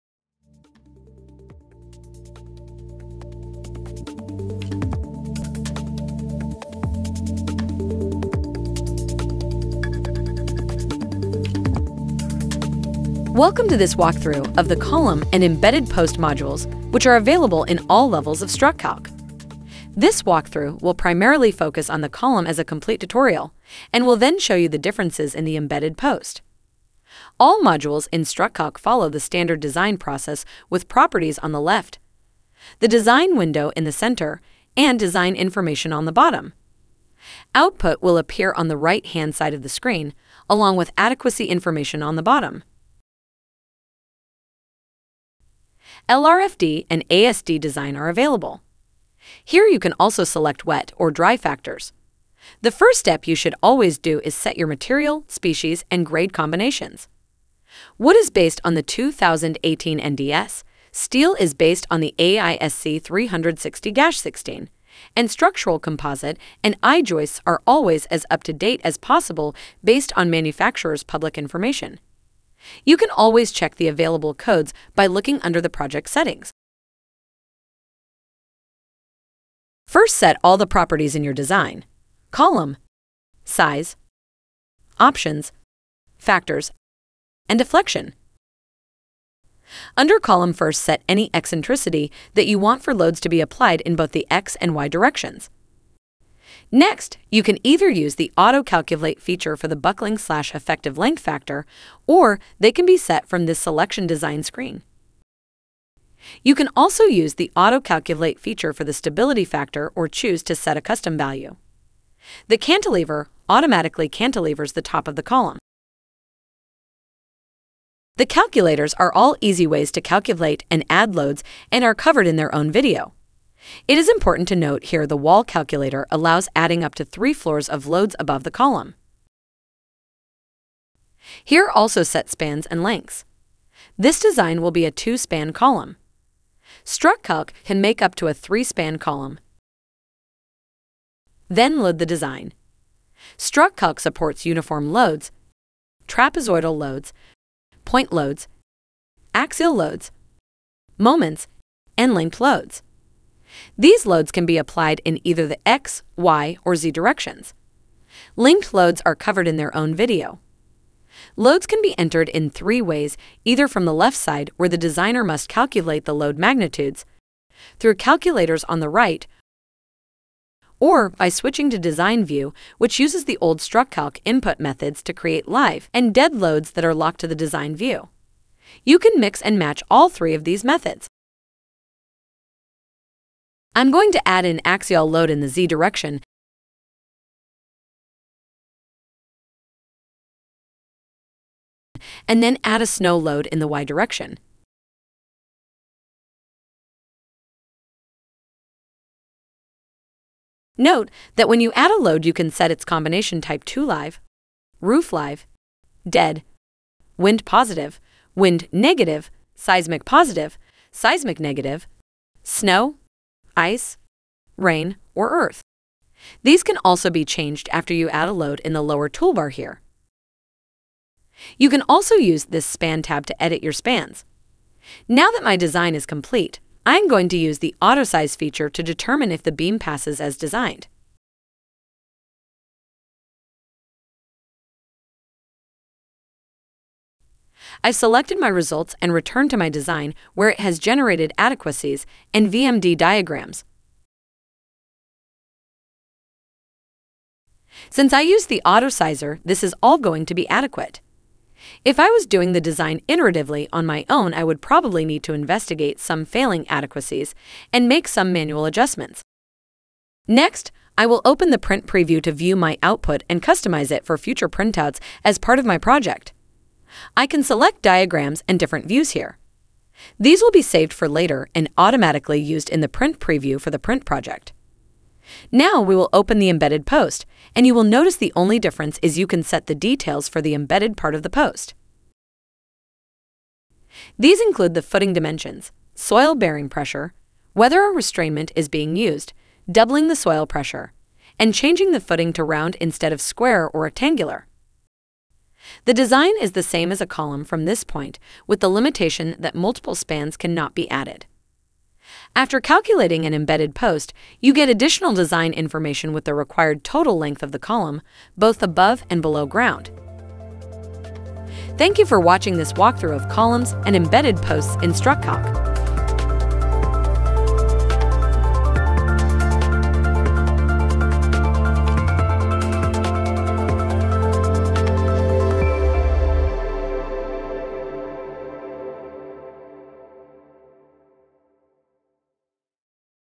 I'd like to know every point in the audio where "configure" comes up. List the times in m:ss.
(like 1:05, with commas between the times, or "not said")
not said.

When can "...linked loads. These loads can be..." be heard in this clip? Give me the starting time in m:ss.
2:32.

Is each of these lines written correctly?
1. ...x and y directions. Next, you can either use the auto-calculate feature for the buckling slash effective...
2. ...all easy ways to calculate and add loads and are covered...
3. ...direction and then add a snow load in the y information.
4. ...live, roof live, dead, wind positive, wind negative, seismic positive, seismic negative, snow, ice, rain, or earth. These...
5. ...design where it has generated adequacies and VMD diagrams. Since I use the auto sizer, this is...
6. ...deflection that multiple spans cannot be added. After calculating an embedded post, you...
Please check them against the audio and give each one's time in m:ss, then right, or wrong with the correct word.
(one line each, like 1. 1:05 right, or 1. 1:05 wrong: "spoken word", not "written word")
1. 1:34 right
2. 1:59 right
3. 3:05 wrong: "direction", not "information"
4. 3:23 right
5. 3:59 right
6. 4:58 wrong: "limitation", not "deflection".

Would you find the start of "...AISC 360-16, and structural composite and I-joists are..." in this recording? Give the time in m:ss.
1:02.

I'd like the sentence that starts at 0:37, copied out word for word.
Output will appear on the right-hand side of the screen, along with adequacy information on the bottom.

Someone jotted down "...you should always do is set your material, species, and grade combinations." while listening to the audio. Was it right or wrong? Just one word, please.
right.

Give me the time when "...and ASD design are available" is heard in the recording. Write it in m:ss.
0:46.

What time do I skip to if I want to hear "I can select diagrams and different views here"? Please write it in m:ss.
4:27.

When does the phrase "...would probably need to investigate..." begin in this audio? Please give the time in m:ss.
4:14.